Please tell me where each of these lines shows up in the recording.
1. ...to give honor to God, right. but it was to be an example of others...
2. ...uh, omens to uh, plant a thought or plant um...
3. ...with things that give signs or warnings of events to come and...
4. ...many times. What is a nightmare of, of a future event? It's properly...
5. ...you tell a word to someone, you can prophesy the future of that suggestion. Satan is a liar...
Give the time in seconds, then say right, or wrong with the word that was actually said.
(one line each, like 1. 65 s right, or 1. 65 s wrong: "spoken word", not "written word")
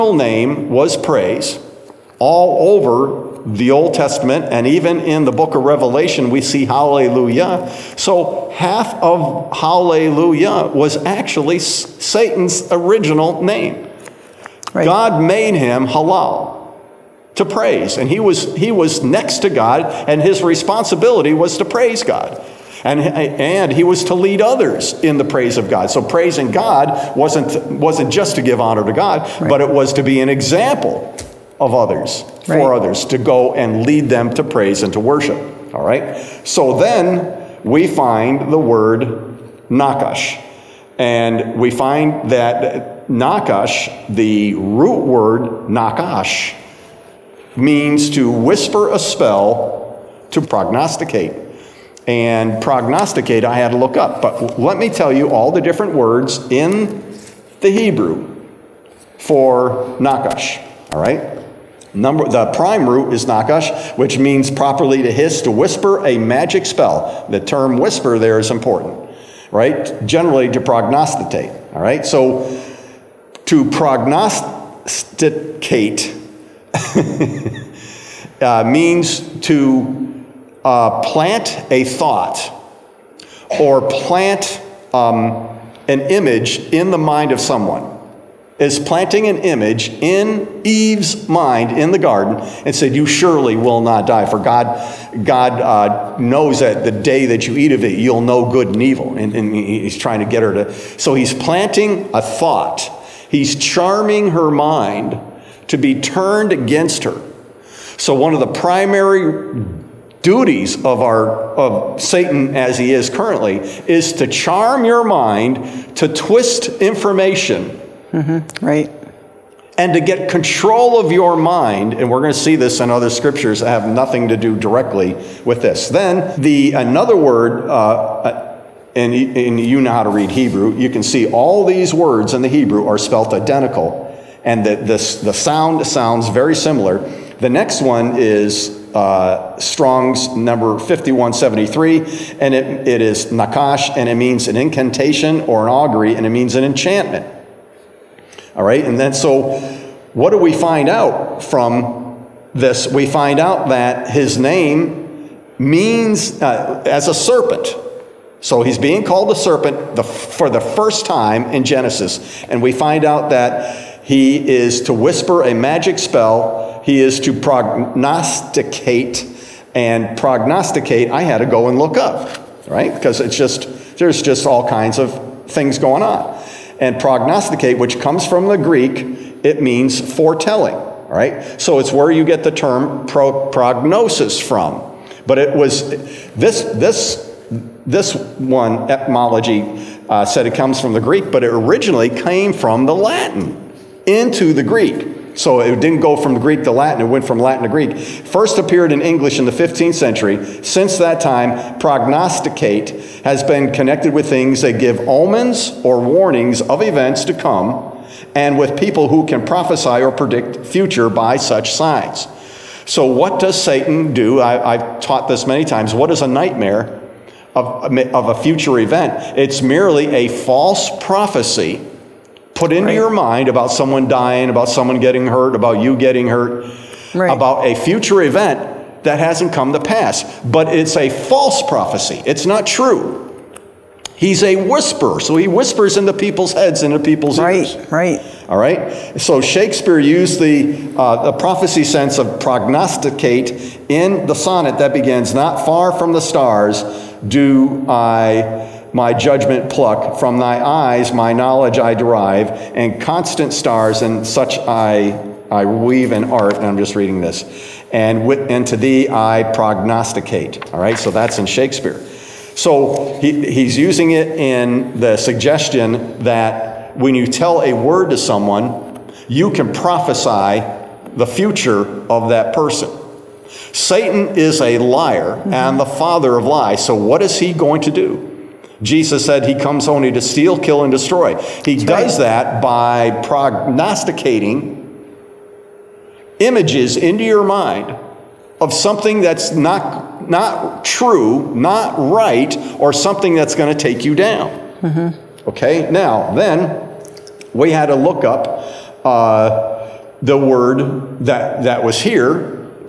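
1. 28 s right
2. 78 s wrong: "means", not "omens"
3. 204 s wrong: "omens", not "signs"
4. 215 s wrong: "merely", not "properly"
5. 267 s wrong: "person", not "suggestion".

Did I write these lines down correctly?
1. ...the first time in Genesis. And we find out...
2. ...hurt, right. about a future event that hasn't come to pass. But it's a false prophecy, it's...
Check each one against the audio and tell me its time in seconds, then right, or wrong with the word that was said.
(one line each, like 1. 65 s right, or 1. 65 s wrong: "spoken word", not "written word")
1. 160 s right
2. 226 s right.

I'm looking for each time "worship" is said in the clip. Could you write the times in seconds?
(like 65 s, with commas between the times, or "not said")
34 s.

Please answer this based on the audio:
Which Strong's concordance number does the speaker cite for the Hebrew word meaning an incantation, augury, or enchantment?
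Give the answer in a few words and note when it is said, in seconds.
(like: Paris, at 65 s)
5173, at 140 s.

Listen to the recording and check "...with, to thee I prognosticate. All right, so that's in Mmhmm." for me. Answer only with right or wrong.
wrong.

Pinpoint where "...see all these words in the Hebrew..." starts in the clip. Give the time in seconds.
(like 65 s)
131 s.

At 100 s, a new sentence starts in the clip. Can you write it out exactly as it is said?
So he's planting a thought, he's charming her mind to be turned against her.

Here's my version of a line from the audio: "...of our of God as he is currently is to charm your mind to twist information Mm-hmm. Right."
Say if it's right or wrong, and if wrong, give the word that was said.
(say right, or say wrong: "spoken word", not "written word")
wrong: "Satan", not "God".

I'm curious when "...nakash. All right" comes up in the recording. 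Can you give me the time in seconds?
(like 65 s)
59 s.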